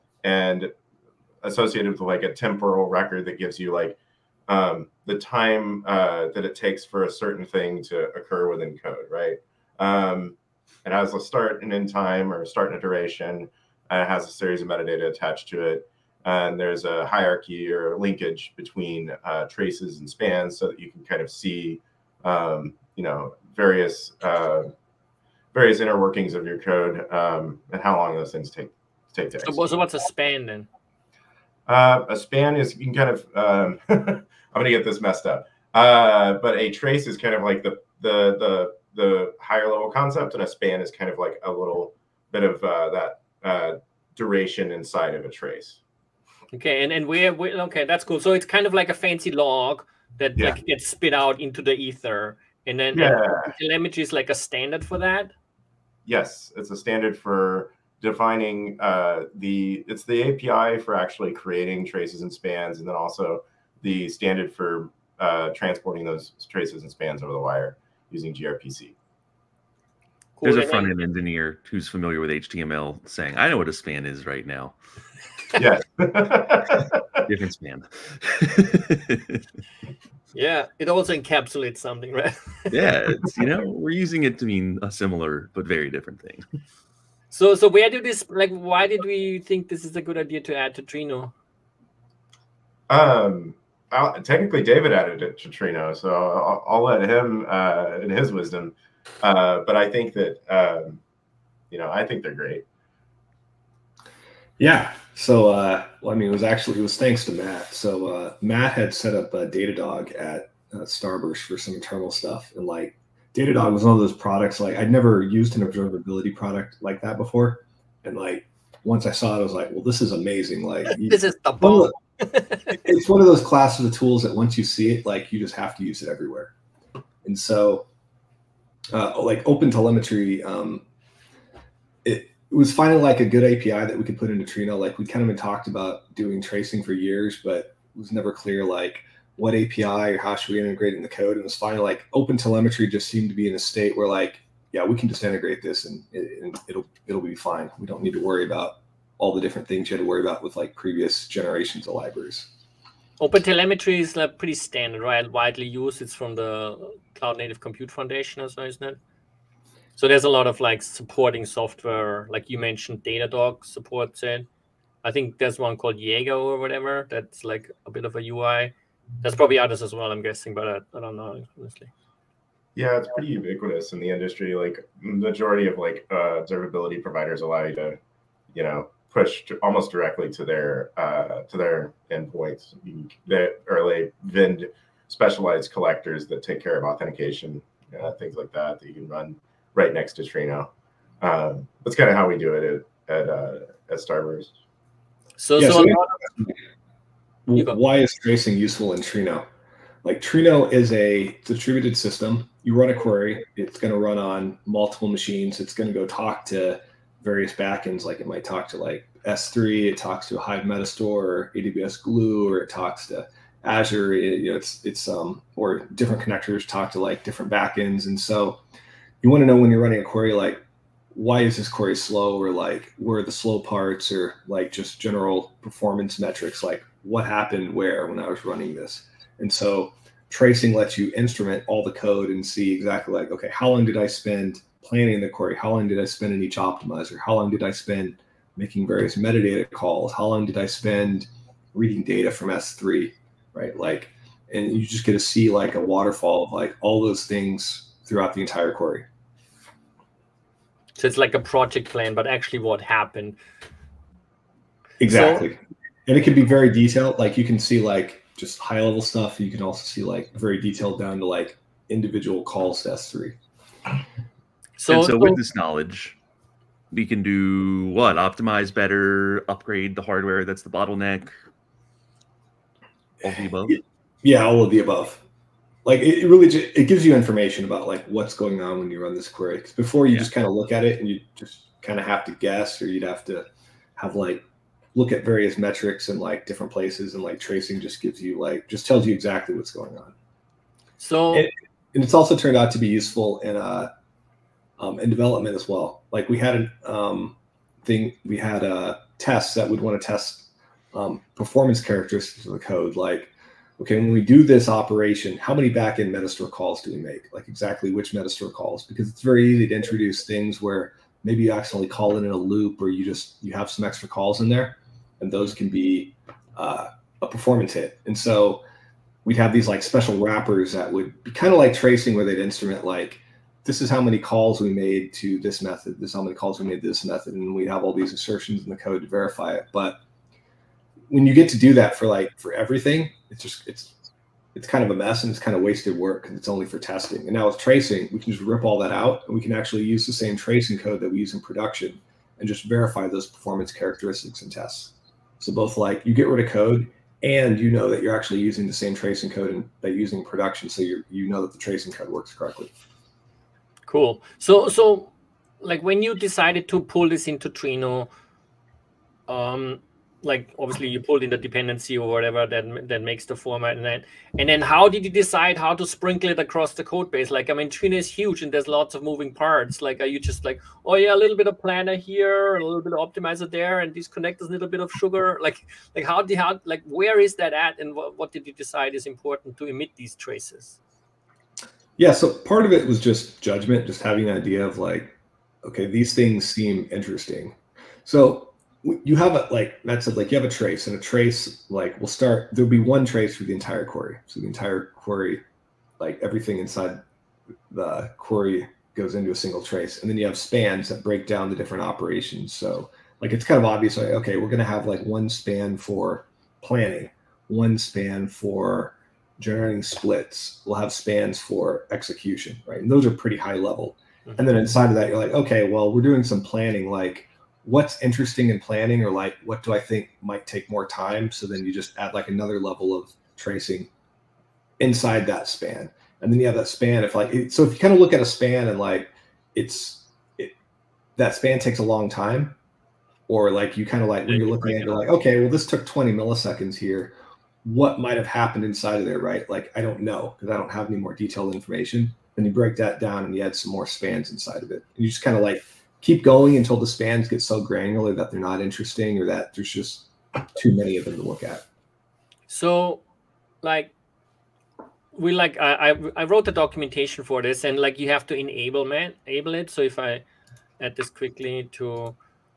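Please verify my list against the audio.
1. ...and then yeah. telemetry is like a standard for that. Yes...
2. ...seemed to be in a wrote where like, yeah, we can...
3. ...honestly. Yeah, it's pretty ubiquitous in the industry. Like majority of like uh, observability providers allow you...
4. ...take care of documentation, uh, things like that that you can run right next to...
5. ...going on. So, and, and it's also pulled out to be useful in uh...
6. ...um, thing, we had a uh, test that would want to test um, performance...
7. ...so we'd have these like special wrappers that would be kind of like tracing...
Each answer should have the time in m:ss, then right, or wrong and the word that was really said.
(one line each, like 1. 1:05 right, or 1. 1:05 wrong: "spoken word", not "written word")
1. 0:52 right
2. 2:23 wrong: "state", not "wrote"
3. 2:51 right
4. 3:06 wrong: "authentication", not "documentation"
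5. 4:49 wrong: "turned", not "pulled"
6. 4:56 right
7. 5:18 right.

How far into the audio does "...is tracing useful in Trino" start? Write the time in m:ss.
3:17.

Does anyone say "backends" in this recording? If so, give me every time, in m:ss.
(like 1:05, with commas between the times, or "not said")
3:27, 3:37, 5:05.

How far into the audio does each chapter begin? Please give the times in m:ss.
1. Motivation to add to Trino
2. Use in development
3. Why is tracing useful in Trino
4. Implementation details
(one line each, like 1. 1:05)
1. 1:26
2. 4:51
3. 3:17
4. 5:53.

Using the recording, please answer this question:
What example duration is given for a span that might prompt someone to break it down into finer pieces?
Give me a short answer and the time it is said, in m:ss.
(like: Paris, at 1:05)
20 milliseconds, at 7:15.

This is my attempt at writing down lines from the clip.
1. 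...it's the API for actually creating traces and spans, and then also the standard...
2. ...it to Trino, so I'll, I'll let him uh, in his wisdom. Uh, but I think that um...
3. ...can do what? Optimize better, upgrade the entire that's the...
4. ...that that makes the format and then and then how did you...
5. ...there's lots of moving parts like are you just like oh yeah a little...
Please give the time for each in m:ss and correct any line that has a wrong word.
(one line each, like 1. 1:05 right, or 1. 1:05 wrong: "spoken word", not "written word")
1. 0:59 right
2. 1:35 right
3. 4:27 wrong: "hardware", not "entire"
4. 6:02 right
5. 6:08 right.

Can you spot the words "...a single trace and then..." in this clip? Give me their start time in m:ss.
6:39.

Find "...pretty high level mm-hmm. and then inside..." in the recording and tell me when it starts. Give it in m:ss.
6:53.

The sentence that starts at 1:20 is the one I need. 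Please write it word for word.
yeah, it also encapsulates something, right?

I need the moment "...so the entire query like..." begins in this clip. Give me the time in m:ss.
6:34.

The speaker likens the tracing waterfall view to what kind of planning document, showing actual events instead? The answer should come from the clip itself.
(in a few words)
project plan.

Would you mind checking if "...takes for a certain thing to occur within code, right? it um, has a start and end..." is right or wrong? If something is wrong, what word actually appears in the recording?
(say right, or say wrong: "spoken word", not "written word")
right.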